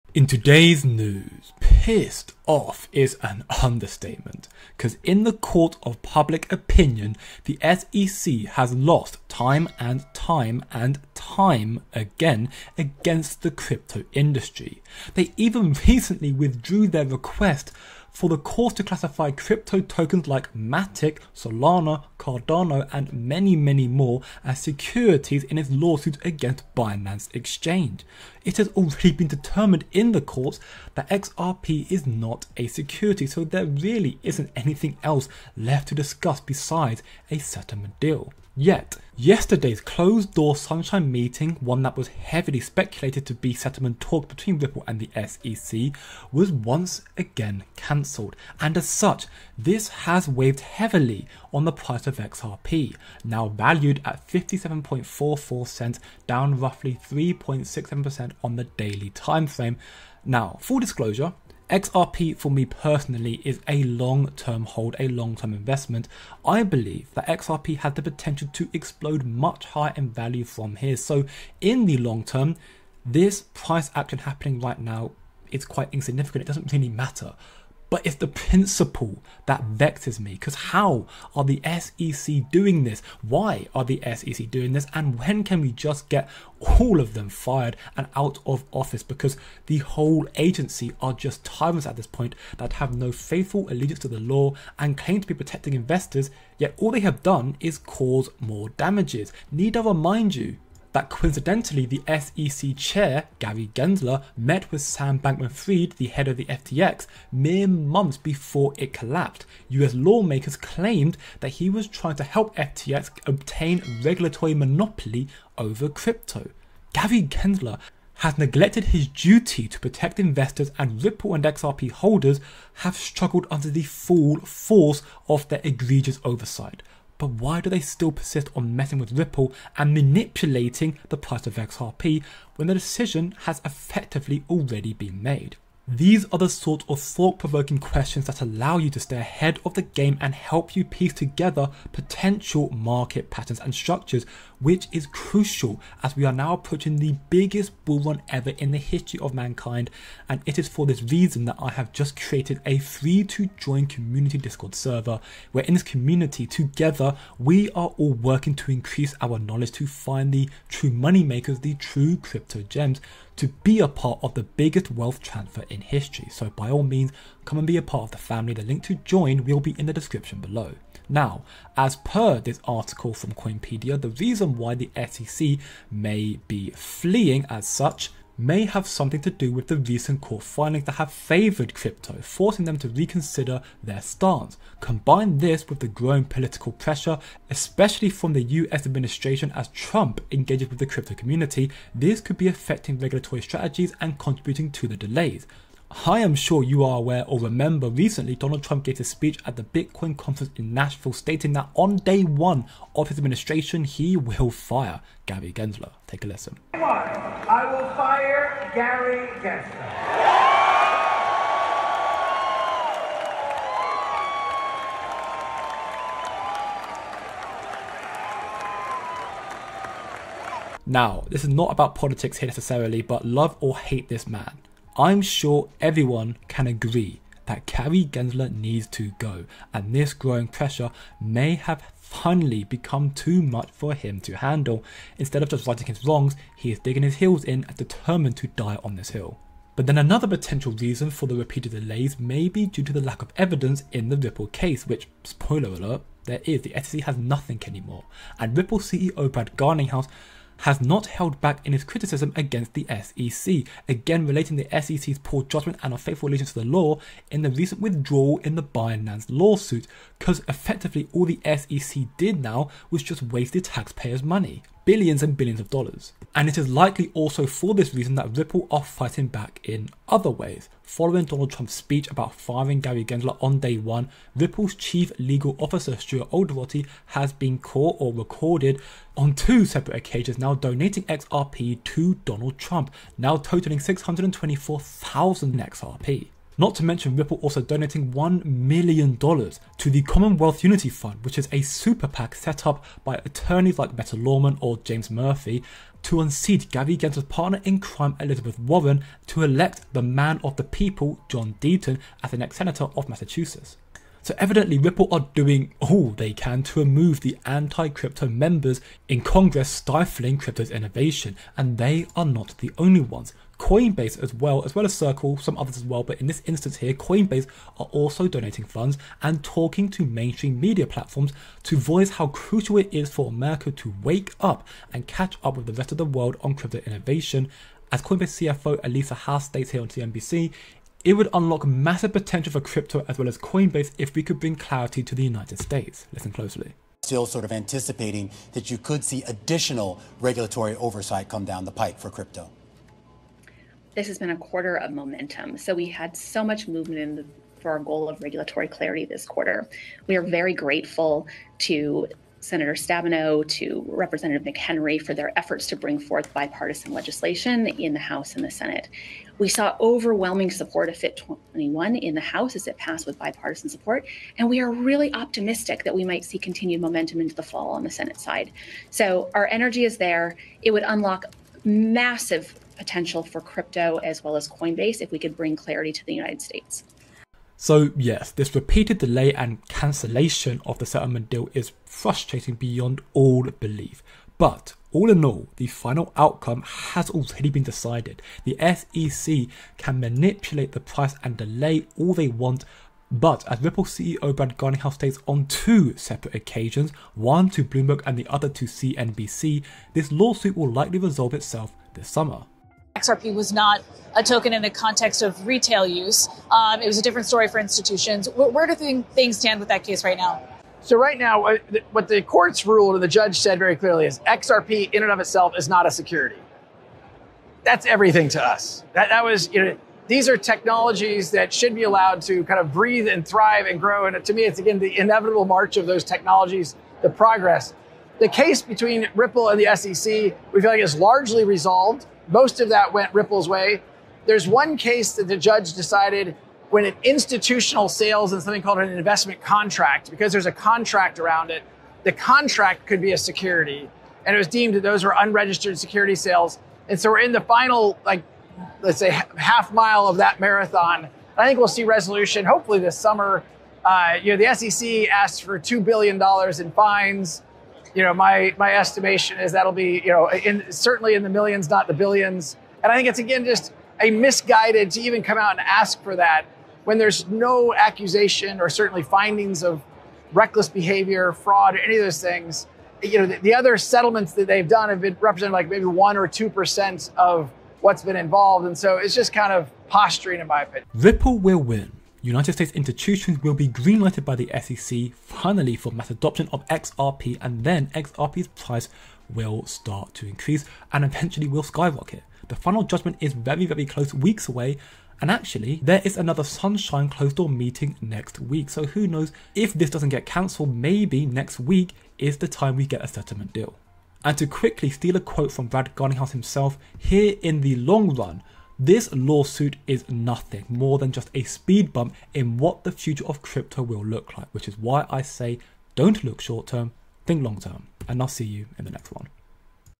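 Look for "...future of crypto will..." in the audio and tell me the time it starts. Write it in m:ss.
8:32.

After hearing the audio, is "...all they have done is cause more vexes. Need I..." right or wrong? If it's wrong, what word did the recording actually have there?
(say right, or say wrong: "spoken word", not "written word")
wrong: "damages", not "vexes".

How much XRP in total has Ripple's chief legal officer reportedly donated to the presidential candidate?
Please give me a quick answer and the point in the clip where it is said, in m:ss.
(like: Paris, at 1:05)
624,000 XRP, at 4:43.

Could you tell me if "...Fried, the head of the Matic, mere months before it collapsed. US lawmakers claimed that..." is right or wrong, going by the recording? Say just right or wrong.
wrong.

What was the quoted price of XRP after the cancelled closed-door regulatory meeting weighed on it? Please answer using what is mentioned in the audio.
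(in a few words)
57.44 cents.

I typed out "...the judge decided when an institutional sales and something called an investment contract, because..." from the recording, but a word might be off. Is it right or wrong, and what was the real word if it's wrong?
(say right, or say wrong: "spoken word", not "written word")
right.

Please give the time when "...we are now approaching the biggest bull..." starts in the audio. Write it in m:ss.
2:26.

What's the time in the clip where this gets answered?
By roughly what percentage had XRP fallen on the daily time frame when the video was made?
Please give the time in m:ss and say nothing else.
0:57.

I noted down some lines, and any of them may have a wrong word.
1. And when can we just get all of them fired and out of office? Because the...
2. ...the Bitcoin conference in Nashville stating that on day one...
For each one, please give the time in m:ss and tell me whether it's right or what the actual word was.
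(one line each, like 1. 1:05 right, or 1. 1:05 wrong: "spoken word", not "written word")
1. 1:24 right
2. 3:19 right.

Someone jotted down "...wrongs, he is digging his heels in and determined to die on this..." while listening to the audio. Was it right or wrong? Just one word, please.
right.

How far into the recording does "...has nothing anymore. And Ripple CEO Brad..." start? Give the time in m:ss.
4:07.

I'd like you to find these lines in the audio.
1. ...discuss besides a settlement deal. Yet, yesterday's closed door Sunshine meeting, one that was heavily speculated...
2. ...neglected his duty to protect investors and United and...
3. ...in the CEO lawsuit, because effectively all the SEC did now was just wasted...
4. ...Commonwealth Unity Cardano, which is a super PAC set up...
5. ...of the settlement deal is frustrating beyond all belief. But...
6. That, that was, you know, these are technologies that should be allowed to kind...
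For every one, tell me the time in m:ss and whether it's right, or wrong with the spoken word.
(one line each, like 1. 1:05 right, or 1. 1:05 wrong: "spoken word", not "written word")
1. 0:35 right
2. 1:58 wrong: "Ripple", not "United"
3. 4:18 wrong: "Binance", not "CEO"
4. 4:50 wrong: "Fund", not "Cardano"
5. 6:20 right
6. 6:58 right.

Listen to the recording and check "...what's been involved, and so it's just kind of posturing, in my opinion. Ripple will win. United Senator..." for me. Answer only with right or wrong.
wrong.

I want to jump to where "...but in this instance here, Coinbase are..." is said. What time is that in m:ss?
5:16.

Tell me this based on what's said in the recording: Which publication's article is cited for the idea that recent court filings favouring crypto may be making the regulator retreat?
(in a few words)
Coinpedia.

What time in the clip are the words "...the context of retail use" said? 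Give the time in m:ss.
6:44.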